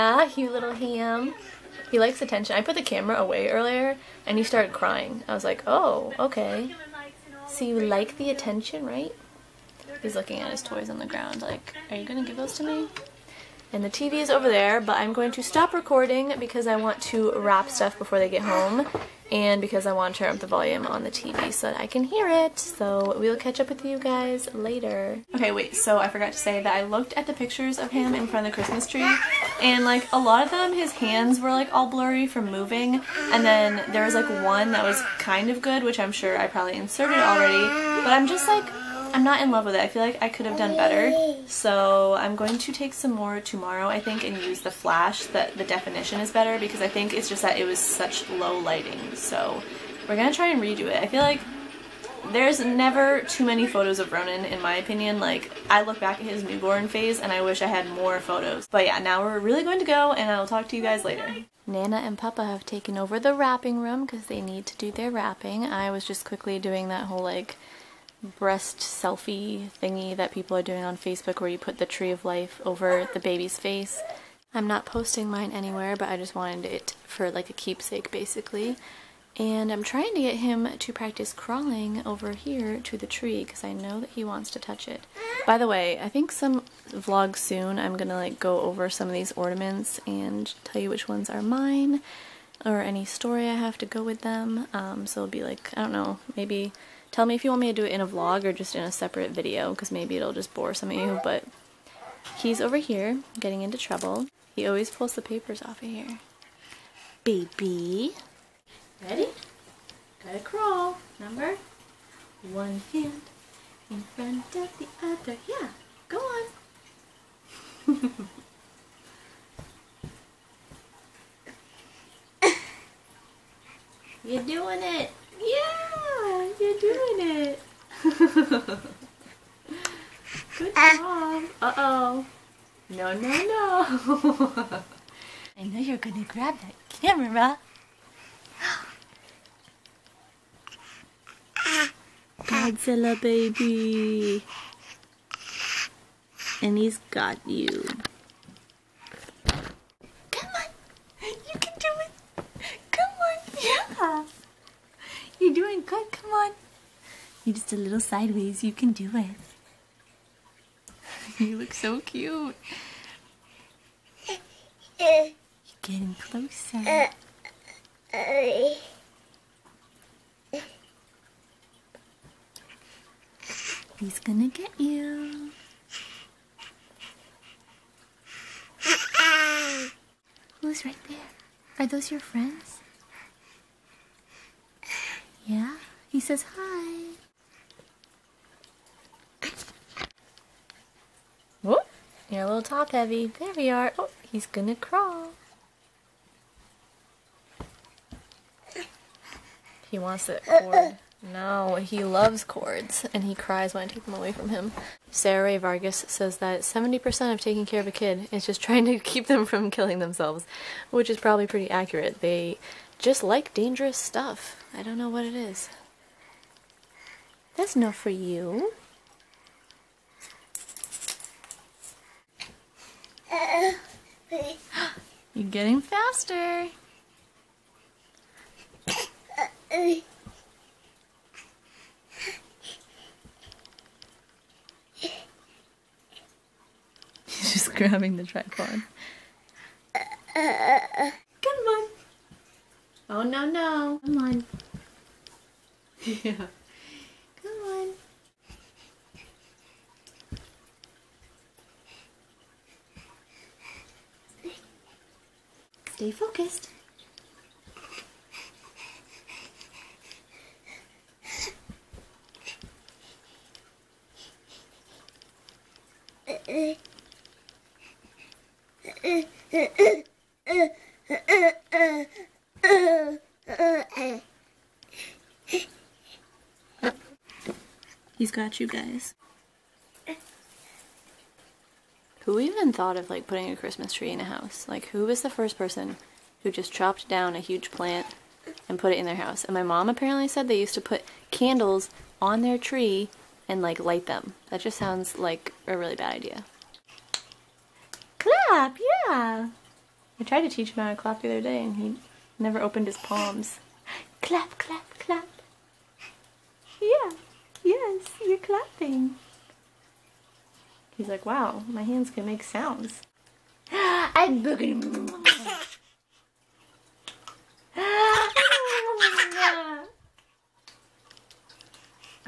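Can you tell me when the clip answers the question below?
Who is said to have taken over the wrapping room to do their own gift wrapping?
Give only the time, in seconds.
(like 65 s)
61 s.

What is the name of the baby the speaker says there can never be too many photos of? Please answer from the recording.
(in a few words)
Ronan.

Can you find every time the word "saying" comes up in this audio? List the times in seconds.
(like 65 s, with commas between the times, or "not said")
not said.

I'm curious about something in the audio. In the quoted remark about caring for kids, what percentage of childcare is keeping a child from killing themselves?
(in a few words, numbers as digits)
70%.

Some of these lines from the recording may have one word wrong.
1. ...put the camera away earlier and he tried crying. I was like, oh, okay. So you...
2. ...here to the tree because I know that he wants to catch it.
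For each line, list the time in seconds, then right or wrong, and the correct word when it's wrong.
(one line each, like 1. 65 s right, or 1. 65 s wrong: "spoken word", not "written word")
1. 2 s wrong: "started", not "tried"
2. 82 s wrong: "touch", not "catch".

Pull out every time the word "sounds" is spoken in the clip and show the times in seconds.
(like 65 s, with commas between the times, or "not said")
294 s, 312 s.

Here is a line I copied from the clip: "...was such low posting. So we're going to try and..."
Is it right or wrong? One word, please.
wrong.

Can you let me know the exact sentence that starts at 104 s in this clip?
He always pulls the papers off of here.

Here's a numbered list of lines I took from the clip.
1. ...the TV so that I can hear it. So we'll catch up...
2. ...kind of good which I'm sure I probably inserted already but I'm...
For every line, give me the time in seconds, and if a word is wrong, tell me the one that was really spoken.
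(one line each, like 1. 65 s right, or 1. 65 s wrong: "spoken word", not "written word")
1. 21 s right
2. 35 s right.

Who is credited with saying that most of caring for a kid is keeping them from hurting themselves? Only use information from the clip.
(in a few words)
Sarah Rae Vargas.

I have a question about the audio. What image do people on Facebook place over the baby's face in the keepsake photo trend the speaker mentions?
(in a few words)
tree of life.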